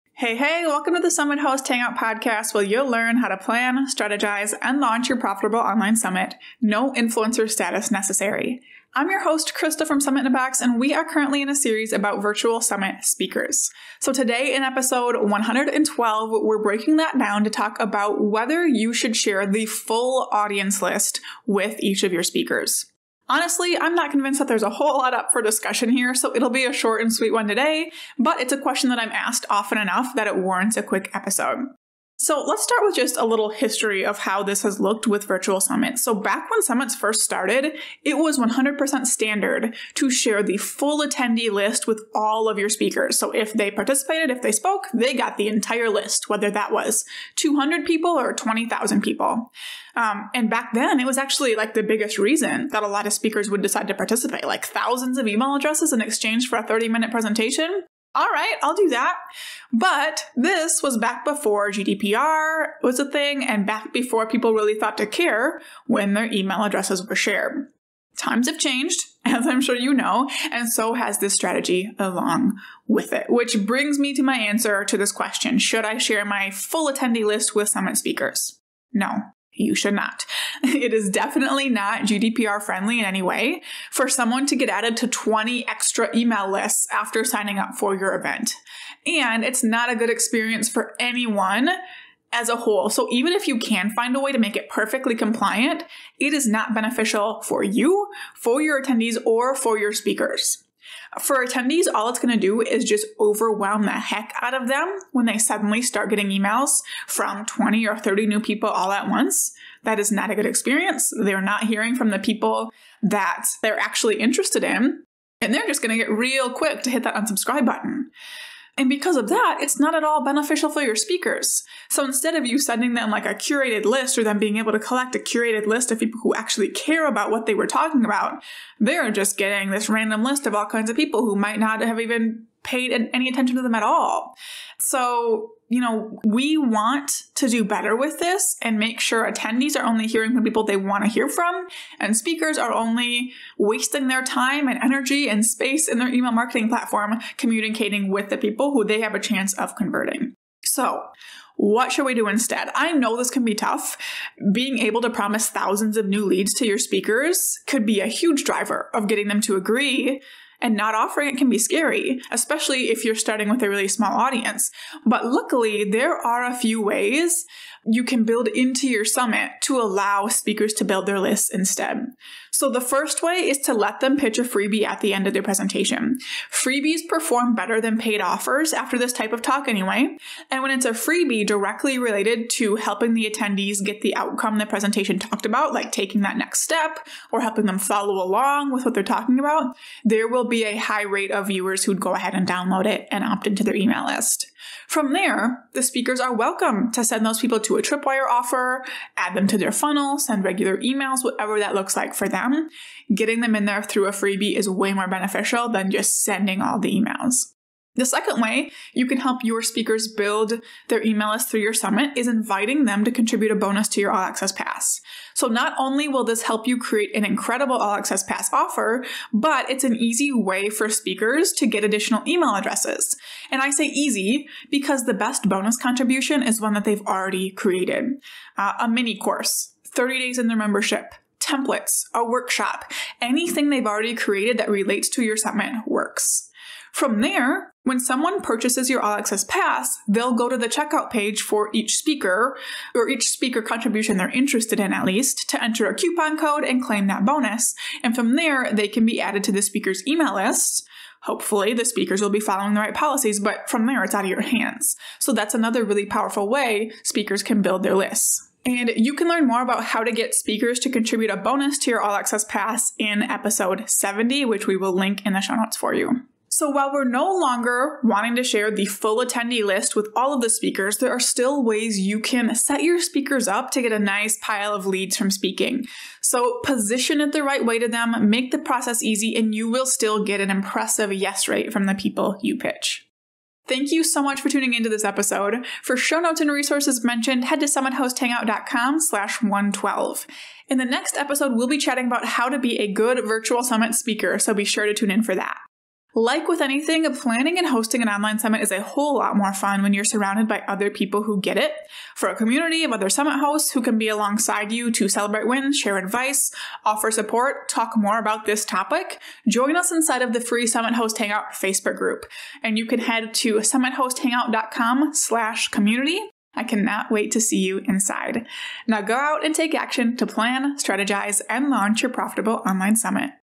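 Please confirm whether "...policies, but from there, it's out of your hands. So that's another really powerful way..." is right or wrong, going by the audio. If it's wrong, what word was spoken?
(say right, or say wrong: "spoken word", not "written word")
right.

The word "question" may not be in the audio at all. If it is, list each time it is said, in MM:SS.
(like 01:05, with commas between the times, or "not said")
00:28, 01:15.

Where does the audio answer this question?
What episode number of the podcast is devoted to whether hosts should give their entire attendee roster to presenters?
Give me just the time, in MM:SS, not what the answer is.
00:14.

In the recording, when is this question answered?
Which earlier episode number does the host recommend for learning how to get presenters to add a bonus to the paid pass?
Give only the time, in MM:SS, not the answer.
04:23.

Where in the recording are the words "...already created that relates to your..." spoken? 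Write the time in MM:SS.
03:53.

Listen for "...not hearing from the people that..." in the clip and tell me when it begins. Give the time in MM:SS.
01:51.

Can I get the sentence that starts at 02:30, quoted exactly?
So, what should we do instead?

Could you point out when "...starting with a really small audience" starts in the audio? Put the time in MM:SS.
02:43.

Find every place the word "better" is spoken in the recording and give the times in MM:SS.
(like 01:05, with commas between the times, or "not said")
02:17, 02:57.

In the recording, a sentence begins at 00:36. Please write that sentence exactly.
So back when summits first started, it was 100% standard to share the full attendee list with all of your speakers.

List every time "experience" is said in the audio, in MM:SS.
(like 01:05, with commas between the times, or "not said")
01:30, 01:50.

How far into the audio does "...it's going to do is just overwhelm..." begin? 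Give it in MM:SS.
01:42.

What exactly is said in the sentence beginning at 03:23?
Getting them in there through a freebie is way more beneficial than just sending all the emails.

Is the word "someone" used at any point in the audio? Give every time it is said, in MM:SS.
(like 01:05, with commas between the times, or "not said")
01:24, 03:57.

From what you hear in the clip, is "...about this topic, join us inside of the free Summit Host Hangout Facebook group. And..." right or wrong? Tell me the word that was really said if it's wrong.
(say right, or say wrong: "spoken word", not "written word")
right.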